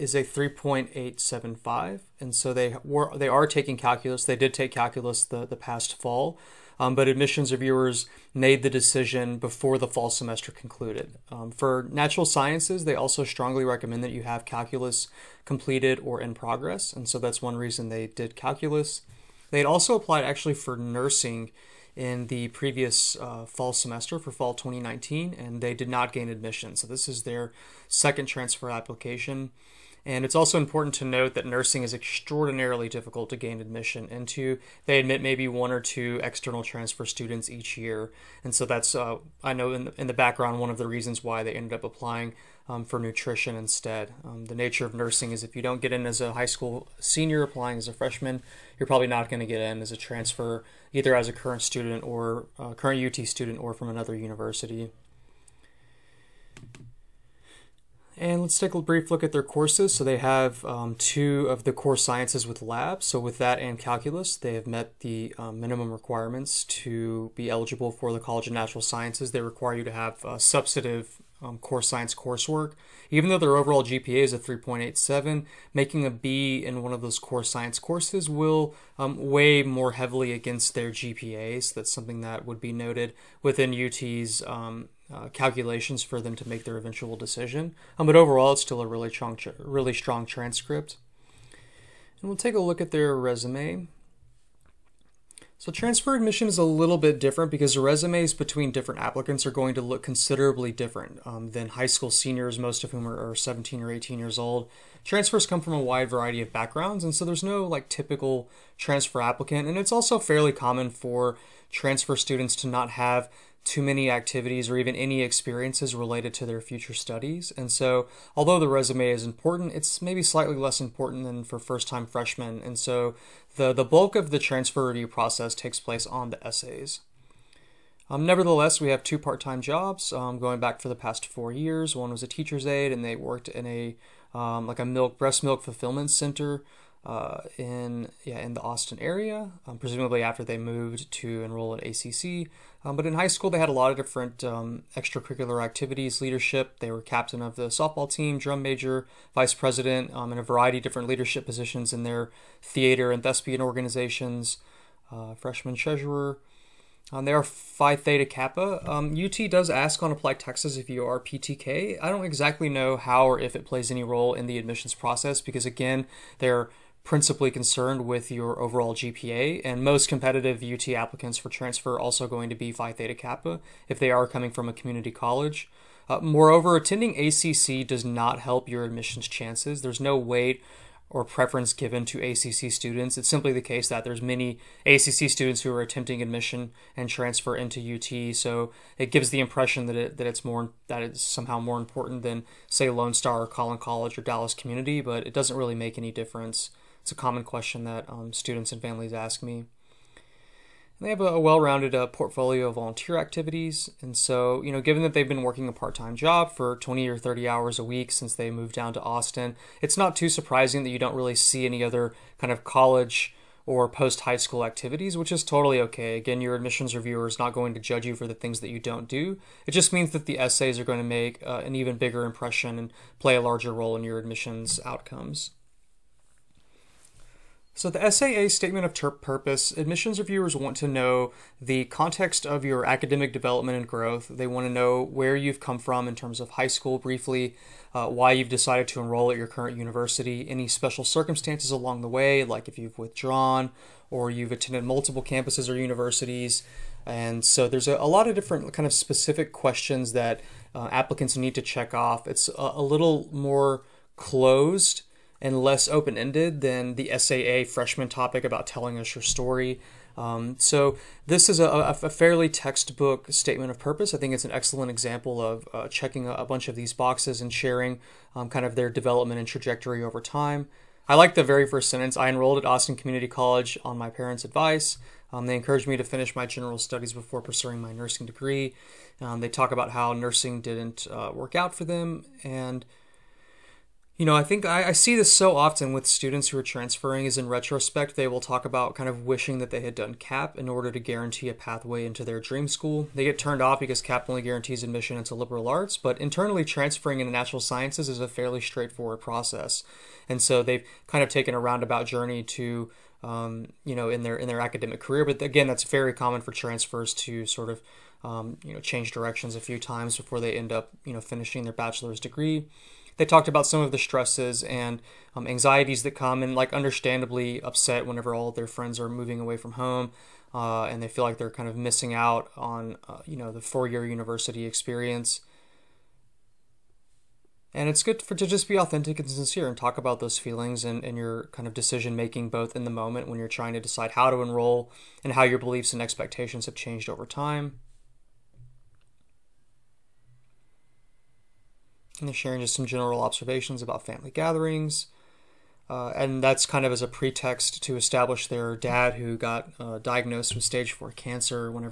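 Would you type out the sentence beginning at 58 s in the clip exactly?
And let's take a brief look at their courses.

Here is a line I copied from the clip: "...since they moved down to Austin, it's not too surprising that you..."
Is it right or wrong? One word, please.
right.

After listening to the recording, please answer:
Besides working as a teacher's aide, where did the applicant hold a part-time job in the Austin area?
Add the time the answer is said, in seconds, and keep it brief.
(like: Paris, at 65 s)
Breast milk fulfillment center, at 135 s.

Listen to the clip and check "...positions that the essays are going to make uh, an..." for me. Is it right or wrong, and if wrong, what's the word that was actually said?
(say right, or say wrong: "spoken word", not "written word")
wrong: "means", not "positions".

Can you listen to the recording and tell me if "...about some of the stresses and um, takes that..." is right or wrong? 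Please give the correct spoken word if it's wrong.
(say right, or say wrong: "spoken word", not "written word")
wrong: "anxieties", not "takes".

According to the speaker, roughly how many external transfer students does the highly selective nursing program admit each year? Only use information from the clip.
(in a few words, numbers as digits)
1 or 2.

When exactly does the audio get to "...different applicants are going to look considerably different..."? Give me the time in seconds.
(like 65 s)
98 s.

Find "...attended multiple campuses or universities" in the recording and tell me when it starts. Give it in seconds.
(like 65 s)
244 s.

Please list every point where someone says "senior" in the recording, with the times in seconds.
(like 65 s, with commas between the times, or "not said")
46 s, 102 s.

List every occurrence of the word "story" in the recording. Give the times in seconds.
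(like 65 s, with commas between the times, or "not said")
259 s.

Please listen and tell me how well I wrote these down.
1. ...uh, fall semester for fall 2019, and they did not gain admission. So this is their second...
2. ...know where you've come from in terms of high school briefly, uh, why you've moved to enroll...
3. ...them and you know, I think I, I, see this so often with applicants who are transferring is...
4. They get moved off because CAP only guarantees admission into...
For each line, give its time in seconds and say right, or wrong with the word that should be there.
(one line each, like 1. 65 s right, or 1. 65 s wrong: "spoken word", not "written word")
1. 23 s right
2. 234 s wrong: "decided", not "moved"
3. 281 s wrong: "students", not "applicants"
4. 293 s wrong: "turned", not "moved".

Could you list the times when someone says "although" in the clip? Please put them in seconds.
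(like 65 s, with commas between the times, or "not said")
118 s.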